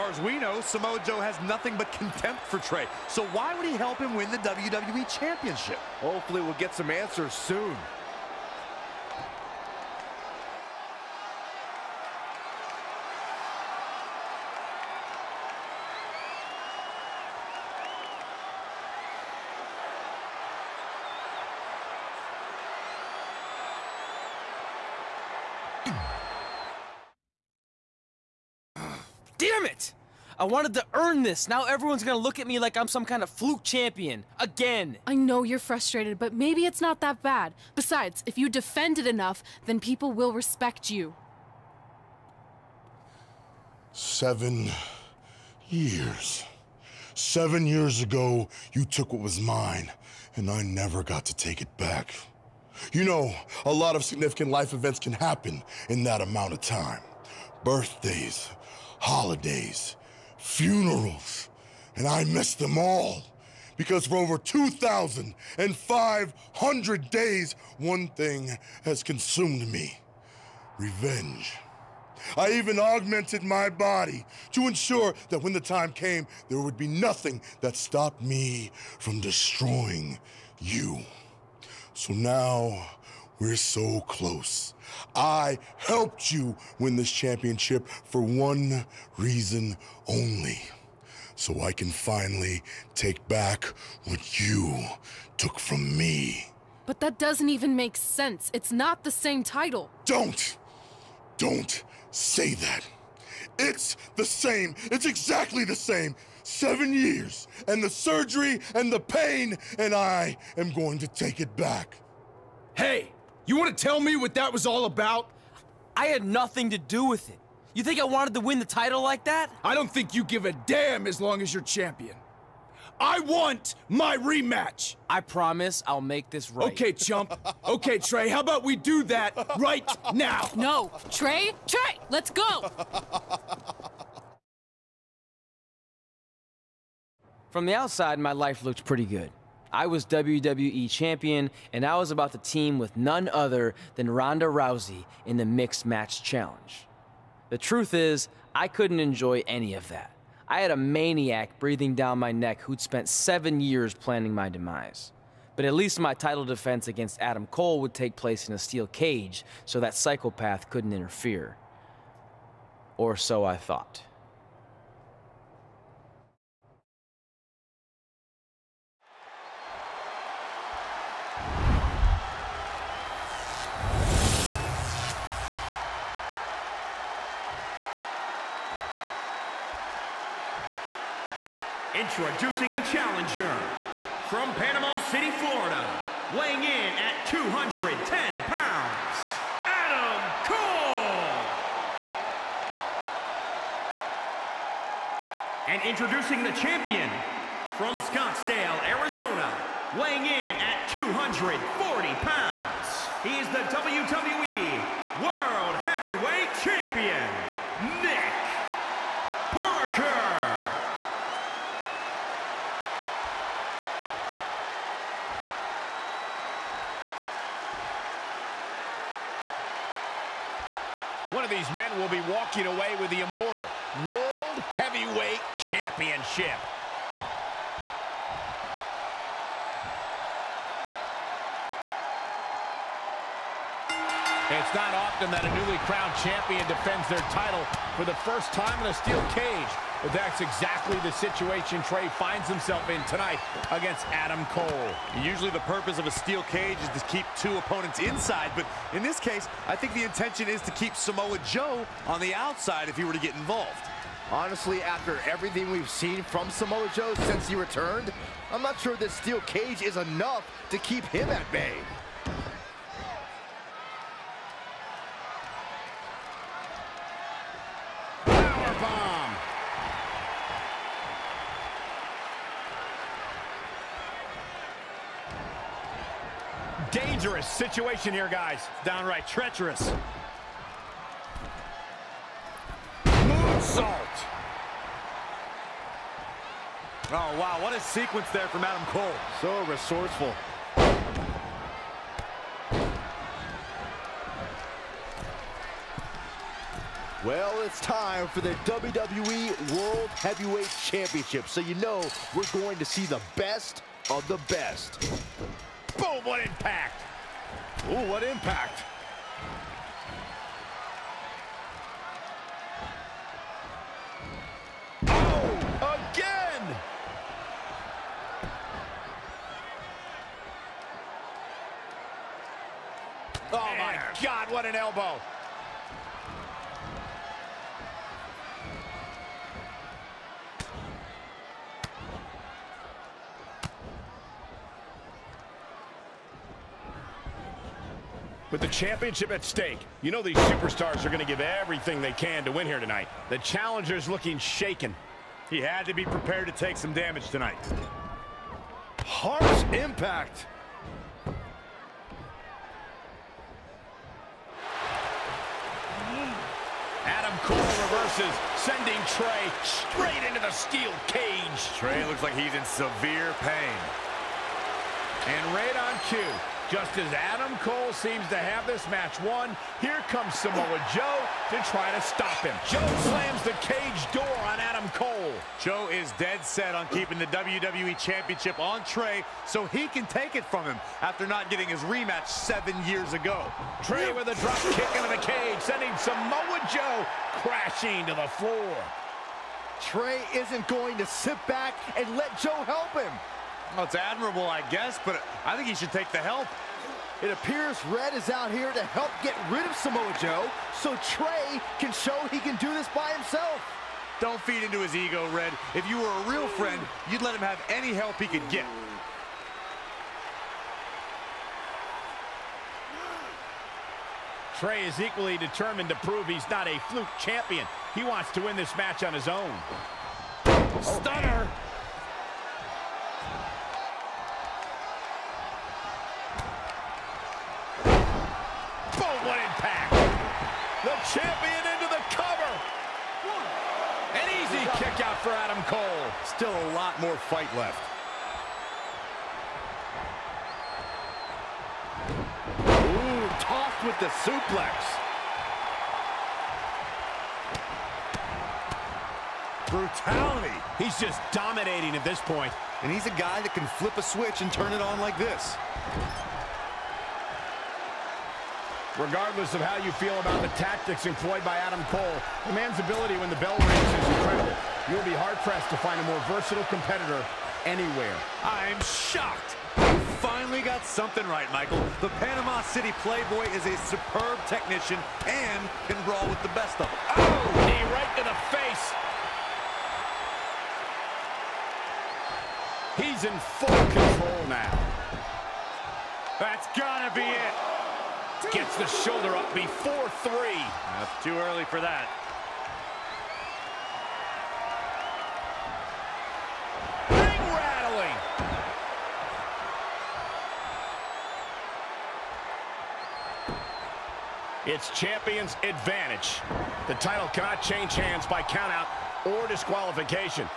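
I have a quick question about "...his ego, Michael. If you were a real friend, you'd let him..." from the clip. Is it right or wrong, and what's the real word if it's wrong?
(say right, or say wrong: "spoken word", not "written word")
wrong: "Red", not "Michael".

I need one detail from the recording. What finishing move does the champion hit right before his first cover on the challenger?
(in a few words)
Stunner.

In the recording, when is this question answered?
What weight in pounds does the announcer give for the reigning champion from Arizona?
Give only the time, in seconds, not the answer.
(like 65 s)
200 s.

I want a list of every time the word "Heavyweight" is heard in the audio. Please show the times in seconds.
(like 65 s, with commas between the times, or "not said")
205 s, 224 s, 300 s.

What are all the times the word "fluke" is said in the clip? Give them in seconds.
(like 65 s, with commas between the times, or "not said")
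33 s, 416 s.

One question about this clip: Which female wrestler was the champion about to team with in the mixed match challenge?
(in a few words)
Ronda Rousey.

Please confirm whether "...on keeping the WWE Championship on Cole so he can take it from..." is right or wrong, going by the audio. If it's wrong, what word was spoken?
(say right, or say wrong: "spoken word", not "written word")
wrong: "Trey", not "Cole".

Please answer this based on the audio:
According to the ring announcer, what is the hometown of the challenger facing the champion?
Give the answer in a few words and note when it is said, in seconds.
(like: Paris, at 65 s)
Panama City, Florida, at 184 s.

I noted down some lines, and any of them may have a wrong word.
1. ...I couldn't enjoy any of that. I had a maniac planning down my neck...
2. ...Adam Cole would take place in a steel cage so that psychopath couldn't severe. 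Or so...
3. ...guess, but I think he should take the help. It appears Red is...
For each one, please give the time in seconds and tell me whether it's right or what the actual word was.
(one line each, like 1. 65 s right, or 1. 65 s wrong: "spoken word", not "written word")
1. 148 s wrong: "breathing", not "planning"
2. 157 s wrong: "interfere", not "severe"
3. 394 s right.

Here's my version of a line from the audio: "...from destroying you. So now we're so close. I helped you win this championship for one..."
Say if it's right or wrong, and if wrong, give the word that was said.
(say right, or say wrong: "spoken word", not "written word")
right.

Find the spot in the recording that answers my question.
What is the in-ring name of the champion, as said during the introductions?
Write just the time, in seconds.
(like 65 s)
208 s.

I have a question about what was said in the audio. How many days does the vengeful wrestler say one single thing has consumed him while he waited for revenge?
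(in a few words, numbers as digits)
2,500.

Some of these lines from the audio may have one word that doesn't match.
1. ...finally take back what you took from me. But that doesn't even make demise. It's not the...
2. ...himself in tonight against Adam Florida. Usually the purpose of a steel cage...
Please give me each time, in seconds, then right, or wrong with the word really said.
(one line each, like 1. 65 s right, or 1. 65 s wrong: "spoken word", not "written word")
1. 91 s wrong: "sense", not "demise"
2. 242 s wrong: "Cole", not "Florida".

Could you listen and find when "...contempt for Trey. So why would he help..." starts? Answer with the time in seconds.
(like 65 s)
1 s.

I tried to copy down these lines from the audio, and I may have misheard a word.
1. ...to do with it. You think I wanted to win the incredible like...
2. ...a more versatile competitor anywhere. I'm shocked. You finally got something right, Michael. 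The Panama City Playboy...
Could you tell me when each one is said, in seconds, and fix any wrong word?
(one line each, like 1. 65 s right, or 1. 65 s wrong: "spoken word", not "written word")
1. 116 s wrong: "title", not "incredible"
2. 465 s right.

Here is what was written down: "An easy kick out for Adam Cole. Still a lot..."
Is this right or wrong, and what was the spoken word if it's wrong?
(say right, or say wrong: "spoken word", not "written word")
right.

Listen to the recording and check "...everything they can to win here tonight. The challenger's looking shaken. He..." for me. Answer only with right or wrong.
right.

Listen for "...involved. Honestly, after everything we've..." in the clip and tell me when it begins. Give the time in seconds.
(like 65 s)
253 s.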